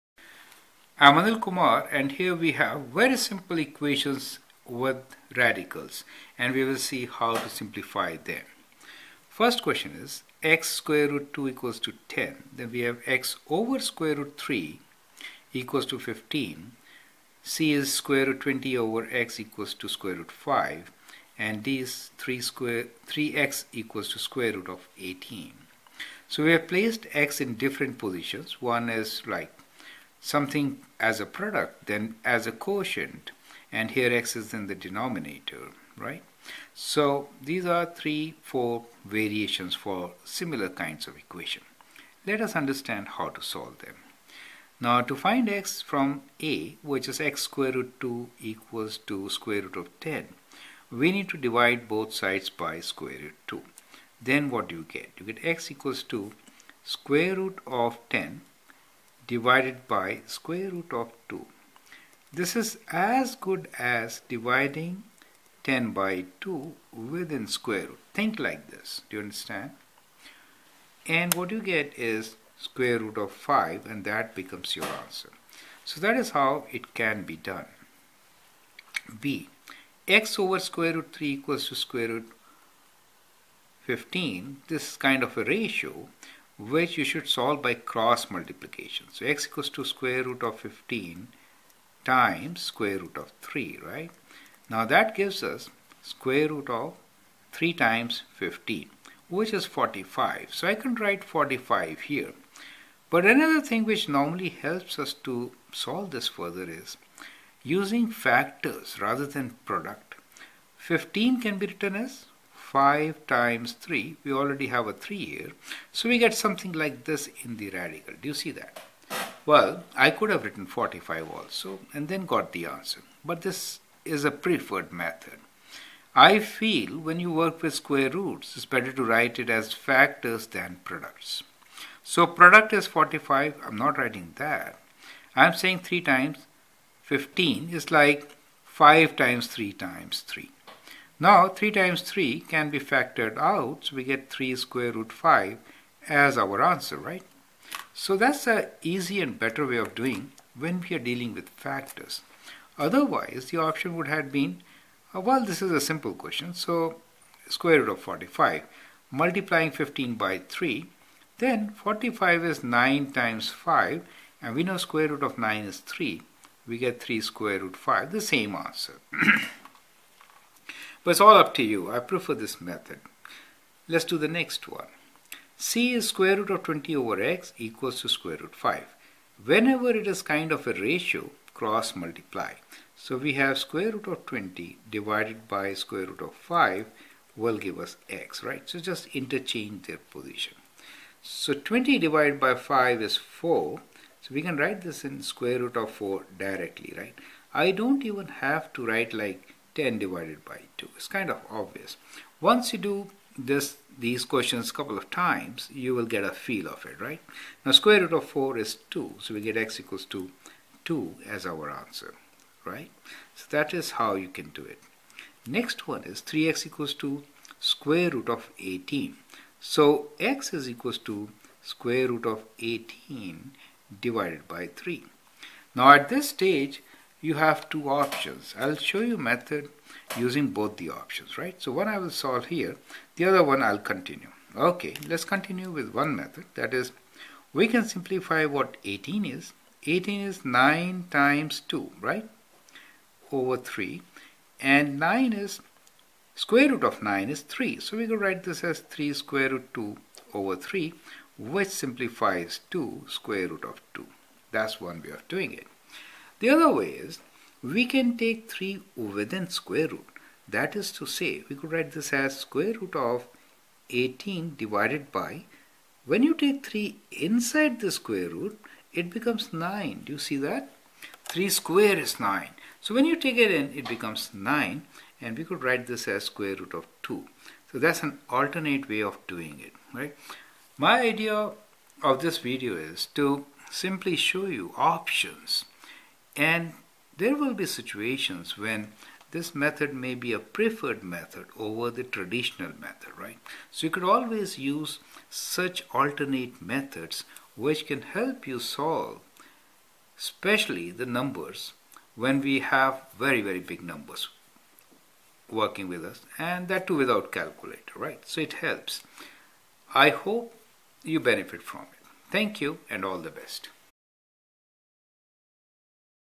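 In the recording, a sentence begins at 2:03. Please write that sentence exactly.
But this is a preferred method.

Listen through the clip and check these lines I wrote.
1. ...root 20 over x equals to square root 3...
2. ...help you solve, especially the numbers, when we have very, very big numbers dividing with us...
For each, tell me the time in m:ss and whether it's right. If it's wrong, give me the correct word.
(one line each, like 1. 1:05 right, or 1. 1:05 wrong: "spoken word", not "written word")
1. 0:18 wrong: "5", not "3"
2. 4:58 wrong: "working", not "dividing".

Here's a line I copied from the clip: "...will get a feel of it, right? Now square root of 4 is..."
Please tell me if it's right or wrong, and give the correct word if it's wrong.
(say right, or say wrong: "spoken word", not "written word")
right.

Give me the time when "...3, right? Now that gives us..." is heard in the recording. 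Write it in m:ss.
1:33.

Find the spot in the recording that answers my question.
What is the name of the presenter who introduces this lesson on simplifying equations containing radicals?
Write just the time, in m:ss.
0:01.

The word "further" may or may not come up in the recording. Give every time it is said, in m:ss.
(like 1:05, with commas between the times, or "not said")
1:46.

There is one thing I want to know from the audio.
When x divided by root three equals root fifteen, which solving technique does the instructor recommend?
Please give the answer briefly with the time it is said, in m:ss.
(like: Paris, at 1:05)
cross multiplication, at 1:27.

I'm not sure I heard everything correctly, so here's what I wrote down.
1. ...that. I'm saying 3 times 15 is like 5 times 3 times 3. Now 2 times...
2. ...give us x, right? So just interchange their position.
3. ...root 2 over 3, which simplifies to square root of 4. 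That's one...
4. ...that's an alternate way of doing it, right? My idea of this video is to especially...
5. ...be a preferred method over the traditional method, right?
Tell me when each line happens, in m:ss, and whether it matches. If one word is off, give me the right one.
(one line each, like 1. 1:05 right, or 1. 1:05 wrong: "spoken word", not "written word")
1. 2:14 wrong: "3", not "2"
2. 3:07 right
3. 4:09 wrong: "2", not "4"
4. 4:37 wrong: "simply", not "especially"
5. 4:50 right.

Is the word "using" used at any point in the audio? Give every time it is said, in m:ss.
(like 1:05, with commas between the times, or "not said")
1:47, 3:50.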